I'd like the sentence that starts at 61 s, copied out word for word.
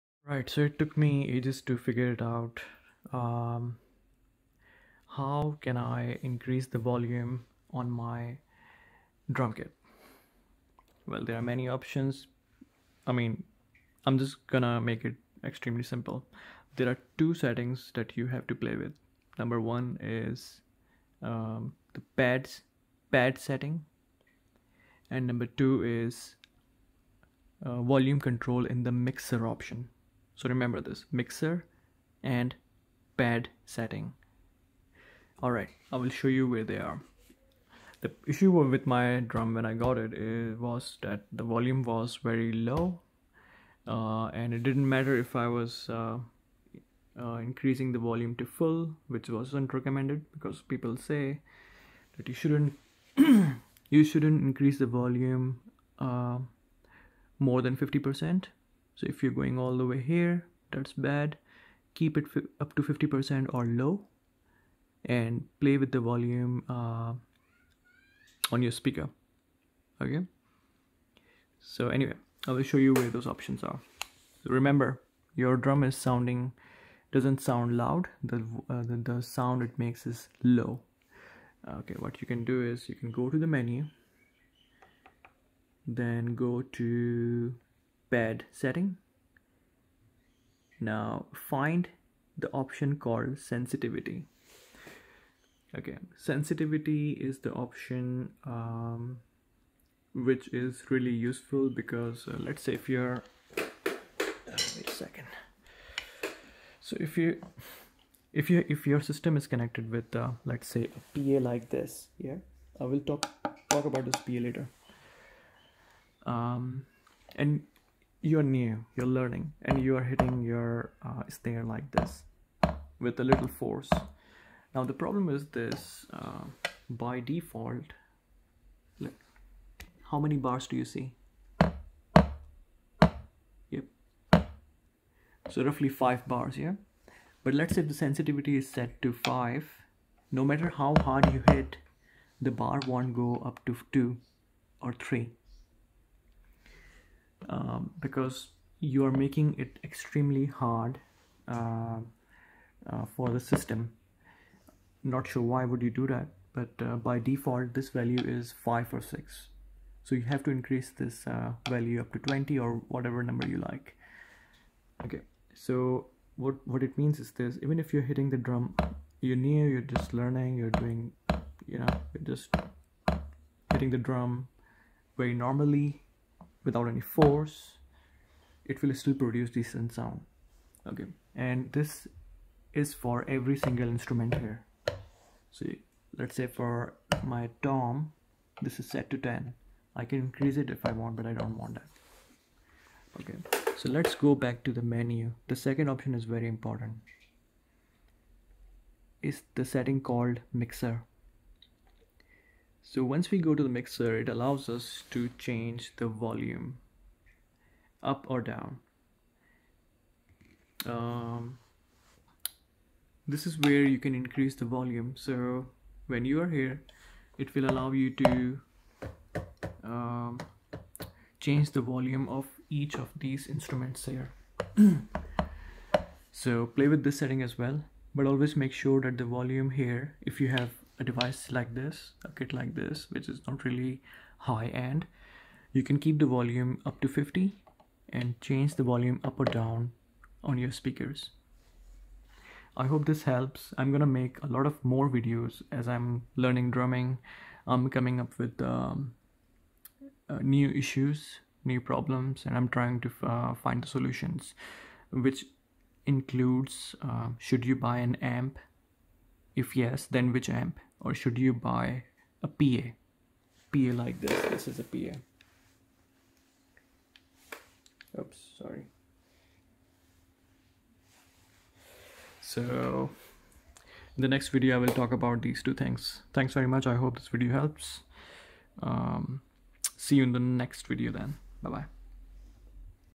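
Keep it up to 50% or low and play with the volume uh, on your speaker.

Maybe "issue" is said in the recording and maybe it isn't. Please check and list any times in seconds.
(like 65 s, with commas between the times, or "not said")
38 s, 250 s.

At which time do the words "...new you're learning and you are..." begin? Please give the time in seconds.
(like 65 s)
118 s.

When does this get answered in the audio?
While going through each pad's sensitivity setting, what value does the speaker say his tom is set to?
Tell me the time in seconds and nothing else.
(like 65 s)
189 s.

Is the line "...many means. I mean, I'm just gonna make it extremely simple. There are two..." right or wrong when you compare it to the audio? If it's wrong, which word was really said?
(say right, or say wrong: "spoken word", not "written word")
wrong: "options", not "means".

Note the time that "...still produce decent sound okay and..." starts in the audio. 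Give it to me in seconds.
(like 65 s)
179 s.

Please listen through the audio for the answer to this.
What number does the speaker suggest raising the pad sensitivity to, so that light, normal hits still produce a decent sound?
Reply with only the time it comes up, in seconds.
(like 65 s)
162 s.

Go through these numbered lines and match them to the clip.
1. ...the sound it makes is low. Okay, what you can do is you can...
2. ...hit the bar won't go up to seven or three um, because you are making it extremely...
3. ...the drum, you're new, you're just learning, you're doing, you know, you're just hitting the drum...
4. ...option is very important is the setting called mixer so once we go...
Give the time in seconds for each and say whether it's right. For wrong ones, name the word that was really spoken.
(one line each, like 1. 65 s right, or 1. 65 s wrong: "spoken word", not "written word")
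1. 78 s right
2. 141 s wrong: "two", not "seven"
3. 168 s right
4. 195 s right.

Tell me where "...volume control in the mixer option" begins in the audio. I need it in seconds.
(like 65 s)
27 s.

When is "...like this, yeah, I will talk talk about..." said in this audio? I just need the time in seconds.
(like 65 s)
111 s.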